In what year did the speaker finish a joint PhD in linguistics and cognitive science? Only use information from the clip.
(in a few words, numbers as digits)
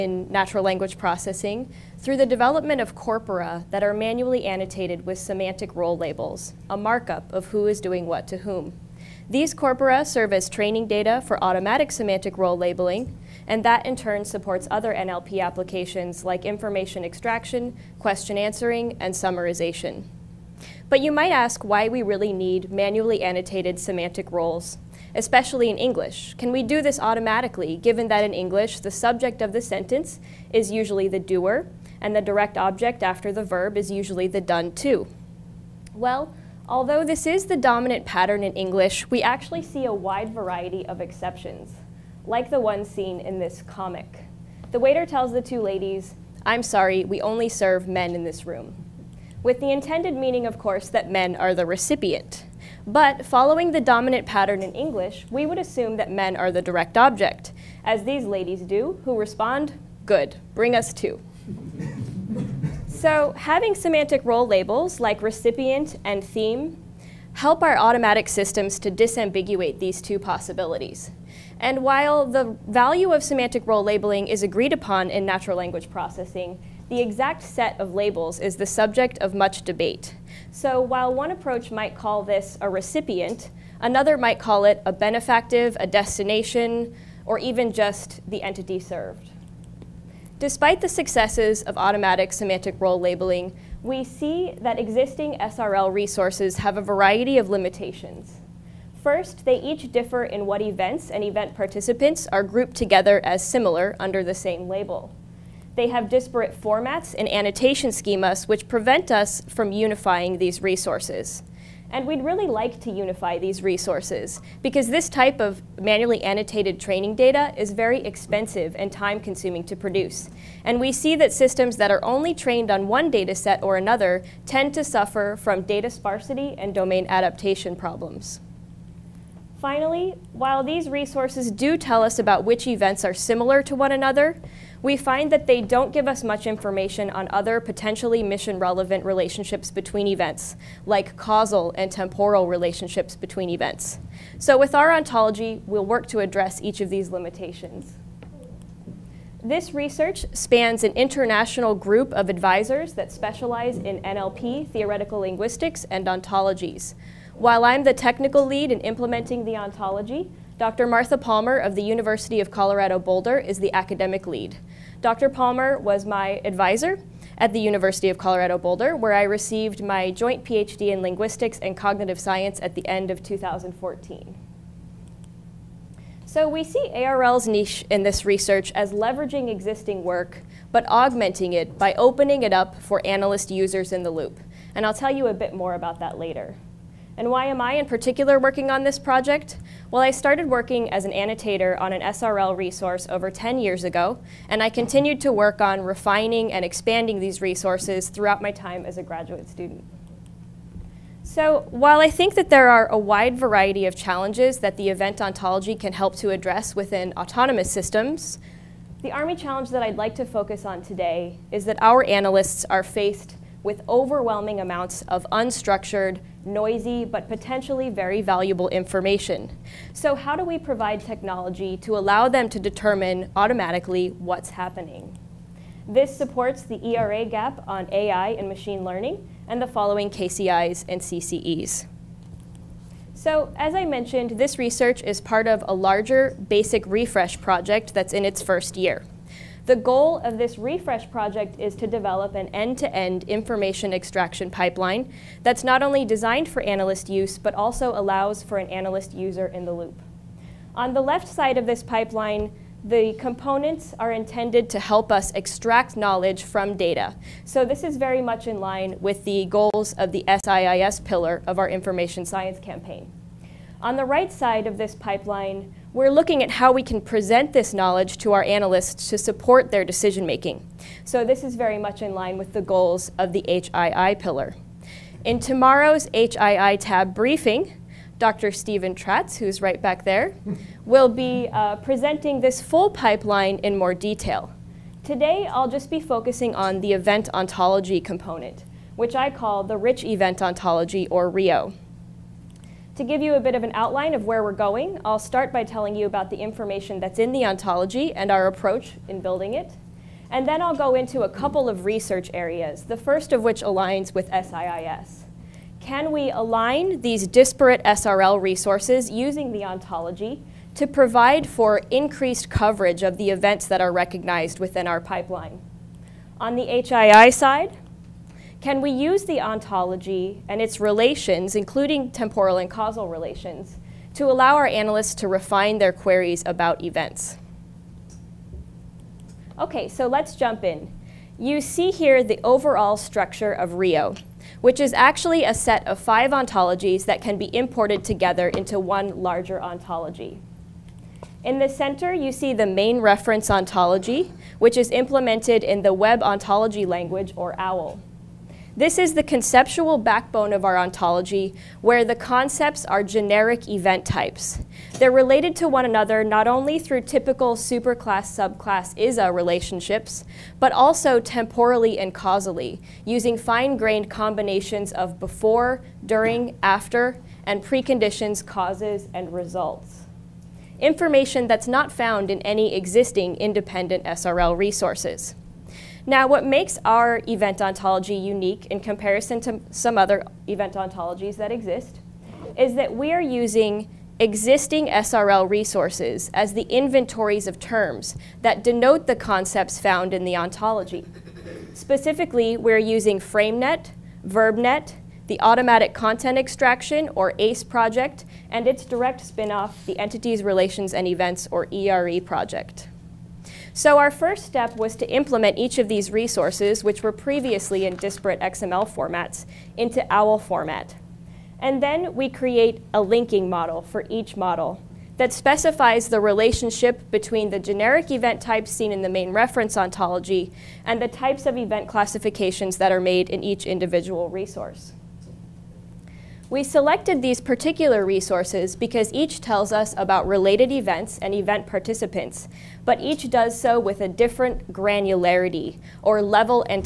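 2014.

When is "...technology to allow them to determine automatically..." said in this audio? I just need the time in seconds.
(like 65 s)
221 s.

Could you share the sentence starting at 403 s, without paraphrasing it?
So our first step was to implement each of these resources, which were previously in disparate XML formats, into OWL format.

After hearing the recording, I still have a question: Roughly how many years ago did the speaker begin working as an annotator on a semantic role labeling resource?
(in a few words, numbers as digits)
over 10 years.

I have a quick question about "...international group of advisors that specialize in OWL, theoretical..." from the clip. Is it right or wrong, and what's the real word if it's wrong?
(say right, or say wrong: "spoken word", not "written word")
wrong: "NLP", not "OWL".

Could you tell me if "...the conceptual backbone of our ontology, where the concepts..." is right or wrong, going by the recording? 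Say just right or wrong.
right.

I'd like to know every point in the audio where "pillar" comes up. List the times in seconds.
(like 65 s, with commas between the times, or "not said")
261 s, 274 s.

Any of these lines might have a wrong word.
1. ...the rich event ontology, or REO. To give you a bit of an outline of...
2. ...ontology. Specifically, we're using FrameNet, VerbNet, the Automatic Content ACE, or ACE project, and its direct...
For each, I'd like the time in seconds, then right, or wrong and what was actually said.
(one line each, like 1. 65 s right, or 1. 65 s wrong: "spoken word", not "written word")
1. 289 s right
2. 390 s wrong: "Extraction", not "ACE".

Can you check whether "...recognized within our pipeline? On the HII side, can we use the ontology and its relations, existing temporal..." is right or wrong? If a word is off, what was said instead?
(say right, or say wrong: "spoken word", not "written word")
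wrong: "including", not "existing".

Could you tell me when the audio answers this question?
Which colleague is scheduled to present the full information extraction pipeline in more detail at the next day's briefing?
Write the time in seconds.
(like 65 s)
278 s.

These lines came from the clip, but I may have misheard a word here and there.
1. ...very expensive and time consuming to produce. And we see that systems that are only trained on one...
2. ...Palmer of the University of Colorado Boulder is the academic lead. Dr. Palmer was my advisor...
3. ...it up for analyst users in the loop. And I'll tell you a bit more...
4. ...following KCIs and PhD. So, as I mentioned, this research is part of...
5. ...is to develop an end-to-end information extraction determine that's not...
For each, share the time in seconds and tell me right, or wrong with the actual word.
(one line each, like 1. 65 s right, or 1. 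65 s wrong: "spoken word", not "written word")
1. 117 s right
2. 161 s right
3. 182 s right
4. 229 s wrong: "CCEs", not "PhD"
5. 241 s wrong: "pipeline", not "determine".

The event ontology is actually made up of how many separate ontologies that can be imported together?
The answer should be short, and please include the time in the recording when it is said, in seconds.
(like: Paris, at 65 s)
5, at 335 s.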